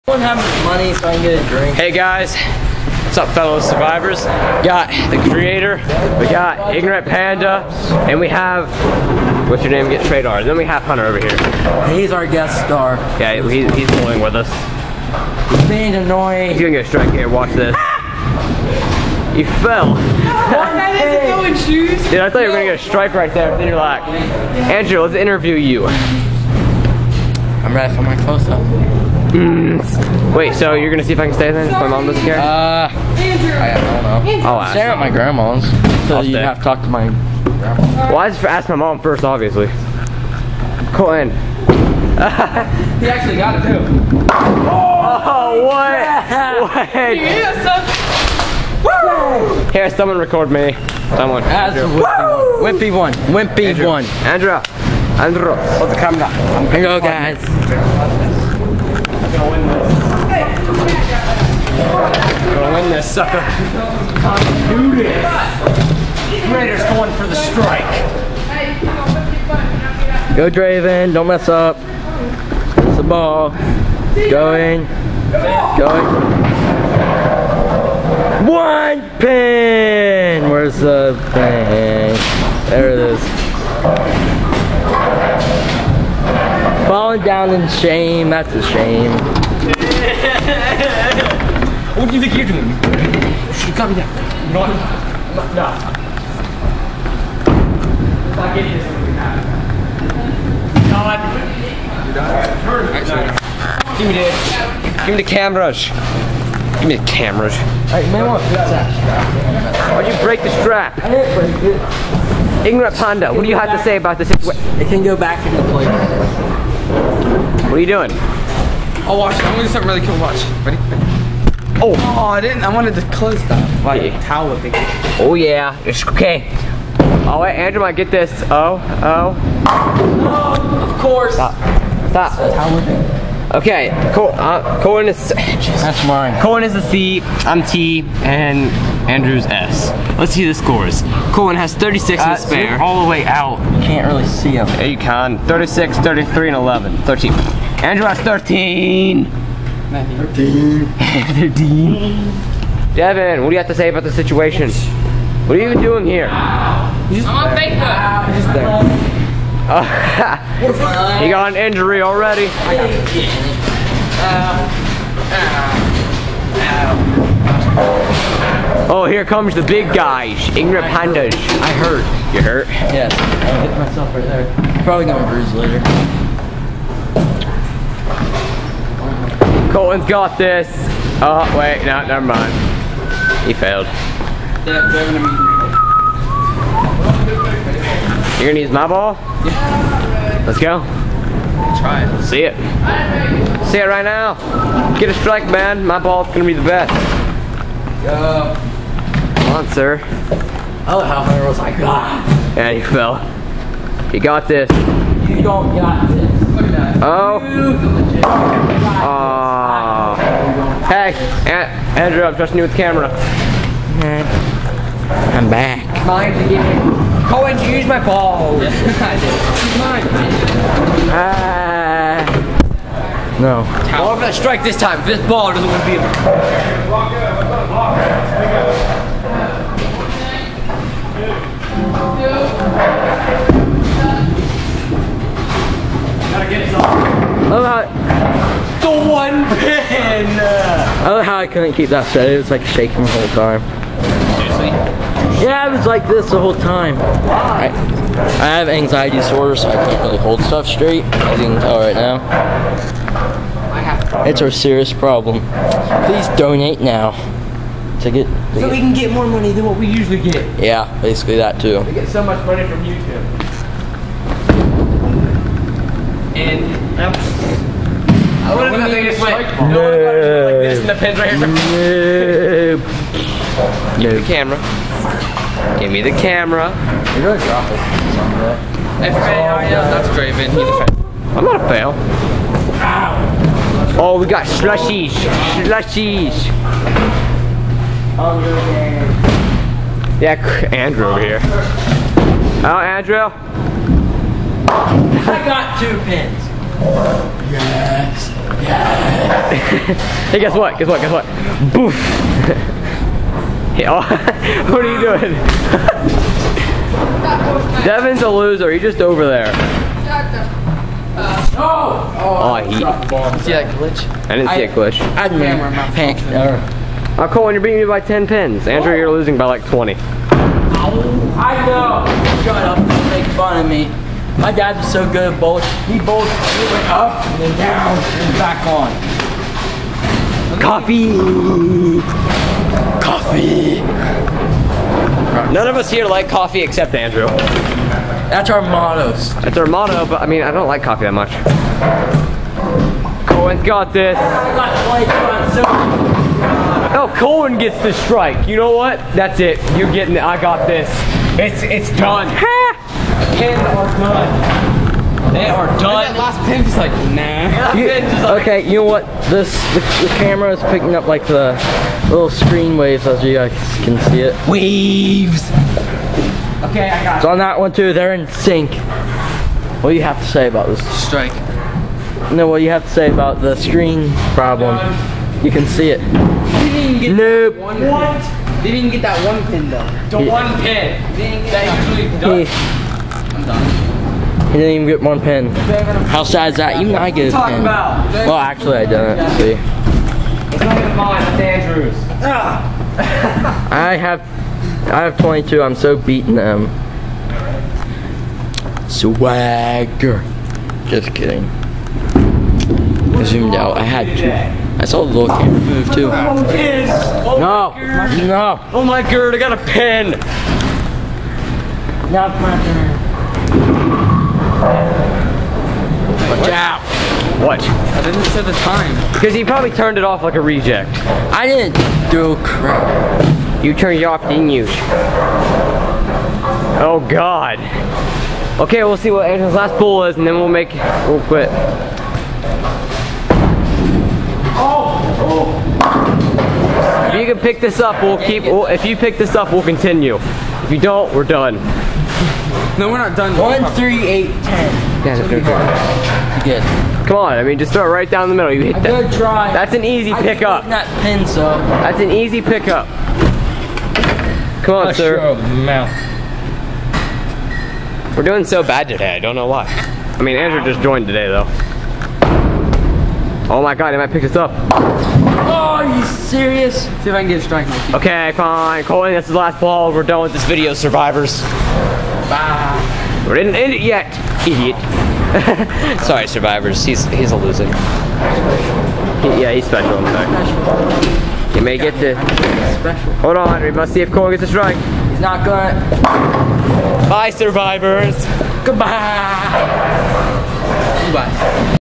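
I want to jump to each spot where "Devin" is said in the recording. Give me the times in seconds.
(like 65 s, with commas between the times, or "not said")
152 s, 307 s.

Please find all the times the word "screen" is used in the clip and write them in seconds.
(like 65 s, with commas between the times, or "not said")
362 s, 373 s.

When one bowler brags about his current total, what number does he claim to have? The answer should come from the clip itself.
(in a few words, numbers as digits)
22.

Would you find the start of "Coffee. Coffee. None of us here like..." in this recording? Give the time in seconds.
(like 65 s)
330 s.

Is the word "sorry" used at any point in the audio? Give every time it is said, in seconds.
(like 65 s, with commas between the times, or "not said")
476 s, 480 s.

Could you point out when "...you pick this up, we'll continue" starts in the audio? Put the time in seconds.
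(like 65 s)
438 s.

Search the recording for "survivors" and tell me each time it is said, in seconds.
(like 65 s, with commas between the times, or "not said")
3 s, 470 s, 476 s, 487 s.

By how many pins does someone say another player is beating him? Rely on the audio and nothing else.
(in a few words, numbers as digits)
10.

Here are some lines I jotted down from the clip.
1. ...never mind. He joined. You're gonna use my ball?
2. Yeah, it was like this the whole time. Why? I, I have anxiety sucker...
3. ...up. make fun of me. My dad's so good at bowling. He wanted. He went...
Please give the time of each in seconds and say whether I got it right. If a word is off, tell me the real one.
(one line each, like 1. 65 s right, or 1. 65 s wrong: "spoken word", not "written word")
1. 182 s wrong: "failed", not "joined"
2. 245 s wrong: "disorder", not "sucker"
3. 322 s wrong: "bowled", not "wanted".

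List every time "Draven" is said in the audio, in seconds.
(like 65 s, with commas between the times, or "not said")
70 s, 280 s.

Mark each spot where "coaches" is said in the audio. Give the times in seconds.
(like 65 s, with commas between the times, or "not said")
not said.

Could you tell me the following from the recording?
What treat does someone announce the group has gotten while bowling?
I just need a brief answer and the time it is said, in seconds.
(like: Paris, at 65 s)
Slushies, at 284 s.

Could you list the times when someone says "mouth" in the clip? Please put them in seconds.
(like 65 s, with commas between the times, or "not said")
455 s.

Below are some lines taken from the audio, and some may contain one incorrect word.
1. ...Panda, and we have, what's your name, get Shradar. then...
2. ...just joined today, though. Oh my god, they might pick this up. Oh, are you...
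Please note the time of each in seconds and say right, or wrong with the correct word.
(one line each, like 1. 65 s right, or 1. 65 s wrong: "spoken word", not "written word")
1. 7 s right
2. 460 s right.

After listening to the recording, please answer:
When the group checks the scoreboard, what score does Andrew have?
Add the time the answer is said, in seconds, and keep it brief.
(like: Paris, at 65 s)
13, at 147 s.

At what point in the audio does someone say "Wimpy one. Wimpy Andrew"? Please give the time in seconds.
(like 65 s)
52 s.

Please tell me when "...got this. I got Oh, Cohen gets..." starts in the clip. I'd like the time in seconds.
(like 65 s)
343 s.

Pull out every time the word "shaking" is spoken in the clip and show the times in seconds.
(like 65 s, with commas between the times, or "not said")
242 s.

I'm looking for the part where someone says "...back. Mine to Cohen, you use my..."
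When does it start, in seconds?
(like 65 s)
215 s.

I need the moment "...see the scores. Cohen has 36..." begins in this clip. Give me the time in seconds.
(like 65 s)
140 s.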